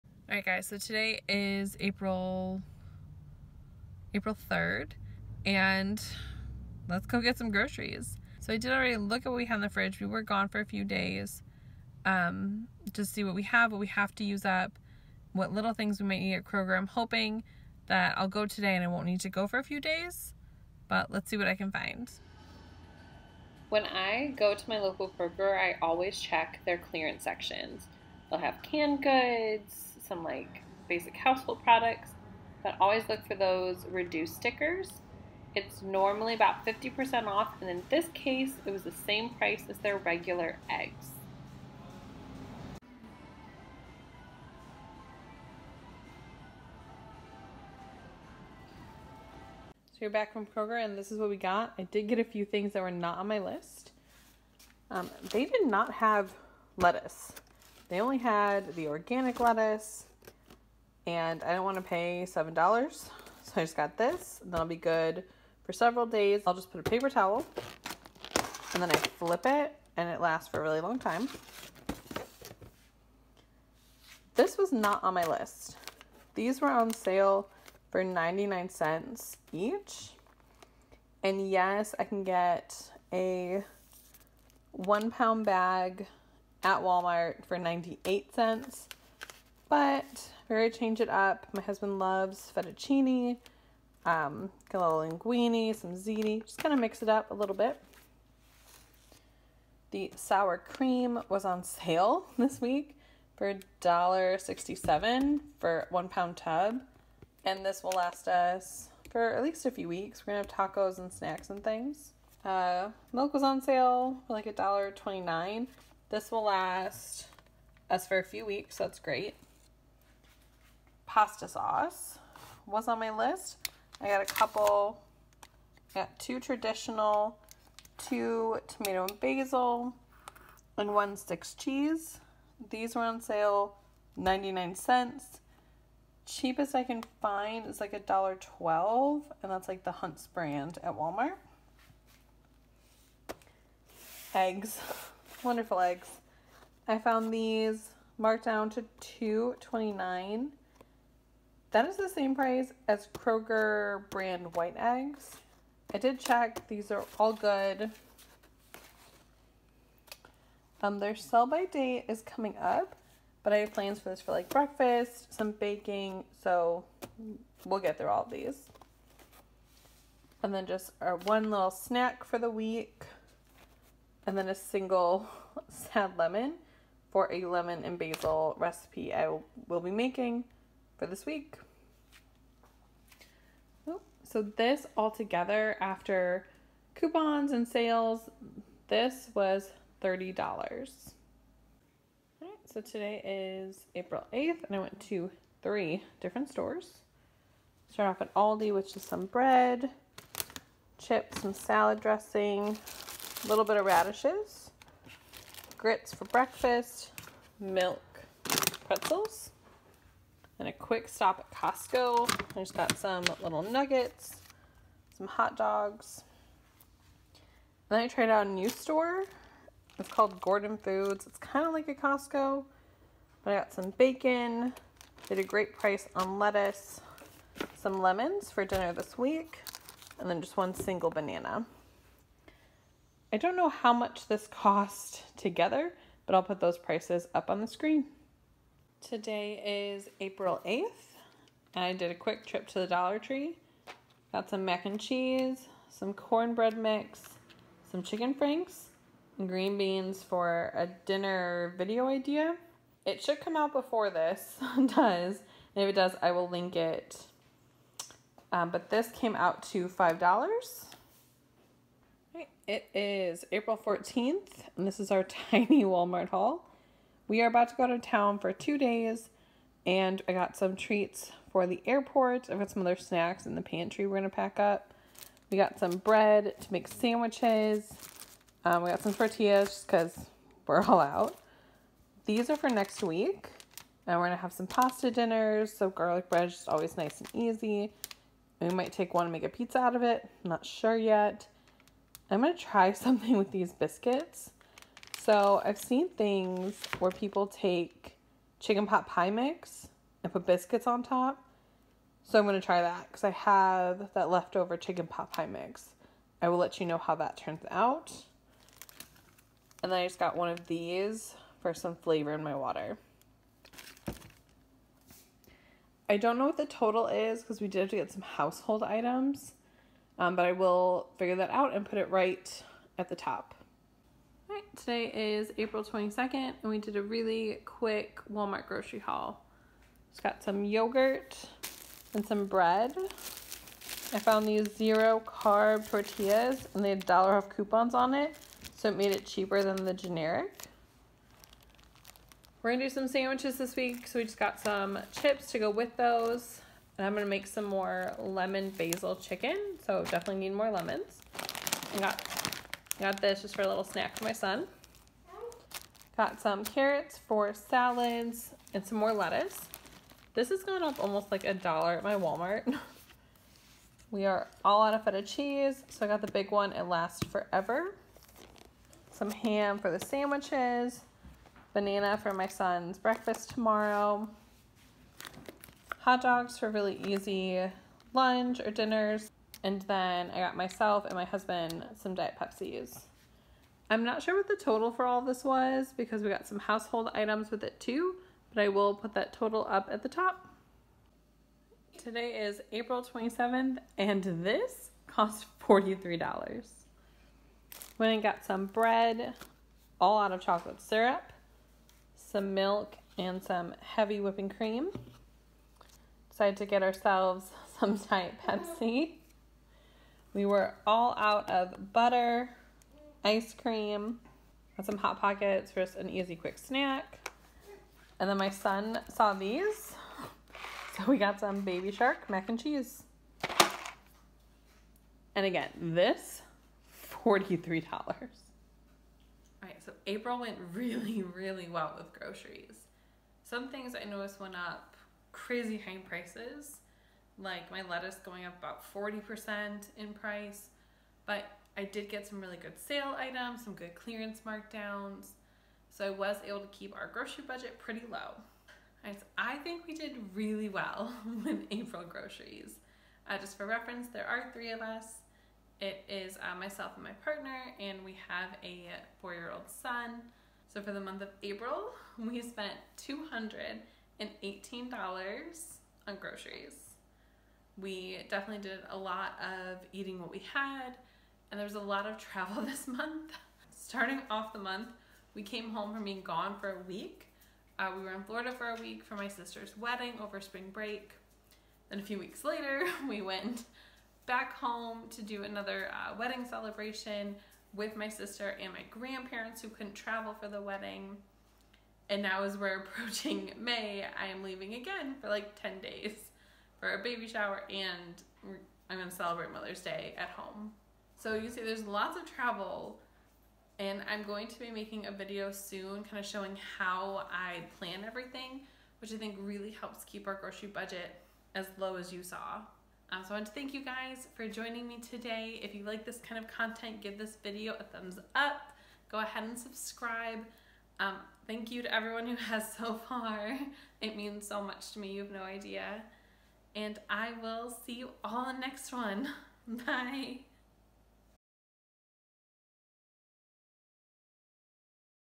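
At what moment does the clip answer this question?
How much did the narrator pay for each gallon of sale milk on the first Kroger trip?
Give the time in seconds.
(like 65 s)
114 s.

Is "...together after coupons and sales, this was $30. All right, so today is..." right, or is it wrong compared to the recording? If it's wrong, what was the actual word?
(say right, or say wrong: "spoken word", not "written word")
right.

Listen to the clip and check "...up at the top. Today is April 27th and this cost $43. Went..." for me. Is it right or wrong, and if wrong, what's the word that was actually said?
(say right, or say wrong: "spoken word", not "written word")
right.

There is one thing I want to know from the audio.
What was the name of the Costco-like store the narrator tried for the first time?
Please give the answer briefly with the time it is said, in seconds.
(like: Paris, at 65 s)
Gordon Foods, at 220 s.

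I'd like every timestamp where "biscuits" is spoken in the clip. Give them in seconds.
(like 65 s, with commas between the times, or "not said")
293 s, 300 s.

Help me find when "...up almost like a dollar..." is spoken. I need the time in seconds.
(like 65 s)
360 s.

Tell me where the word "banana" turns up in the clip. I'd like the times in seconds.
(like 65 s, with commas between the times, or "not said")
231 s, 371 s.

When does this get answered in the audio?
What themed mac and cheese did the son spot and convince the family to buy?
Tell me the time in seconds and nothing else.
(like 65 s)
421 s.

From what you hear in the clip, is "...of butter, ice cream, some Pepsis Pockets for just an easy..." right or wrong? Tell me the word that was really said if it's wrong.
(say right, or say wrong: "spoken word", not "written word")
wrong: "Hot", not "Pepsis".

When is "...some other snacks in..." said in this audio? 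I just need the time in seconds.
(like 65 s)
272 s.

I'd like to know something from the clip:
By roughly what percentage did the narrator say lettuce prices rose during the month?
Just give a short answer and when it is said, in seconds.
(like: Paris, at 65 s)
40%, at 438 s.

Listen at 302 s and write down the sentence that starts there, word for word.
So I'm going to try that because I have that leftover chicken pot pie mix.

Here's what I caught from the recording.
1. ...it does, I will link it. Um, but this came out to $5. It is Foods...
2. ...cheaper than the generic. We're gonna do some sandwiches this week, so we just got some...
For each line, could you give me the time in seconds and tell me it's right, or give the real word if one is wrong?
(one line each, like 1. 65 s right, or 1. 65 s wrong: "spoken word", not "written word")
1. 255 s wrong: "April", not "Foods"
2. 339 s right.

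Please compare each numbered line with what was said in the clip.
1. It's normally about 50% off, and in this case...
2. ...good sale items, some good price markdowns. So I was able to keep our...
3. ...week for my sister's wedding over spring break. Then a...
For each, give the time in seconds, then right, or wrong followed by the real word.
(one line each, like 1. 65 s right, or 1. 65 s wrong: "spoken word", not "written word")
1. 35 s right
2. 442 s wrong: "clearance", not "price"
3. 478 s right.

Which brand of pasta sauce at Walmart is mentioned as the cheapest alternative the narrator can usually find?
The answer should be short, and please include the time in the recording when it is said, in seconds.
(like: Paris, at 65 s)
Hunts, at 139 s.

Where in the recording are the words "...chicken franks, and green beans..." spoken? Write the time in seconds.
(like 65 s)
248 s.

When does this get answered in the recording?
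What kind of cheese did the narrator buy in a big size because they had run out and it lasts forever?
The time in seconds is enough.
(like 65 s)
365 s.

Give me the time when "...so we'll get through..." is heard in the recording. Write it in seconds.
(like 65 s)
166 s.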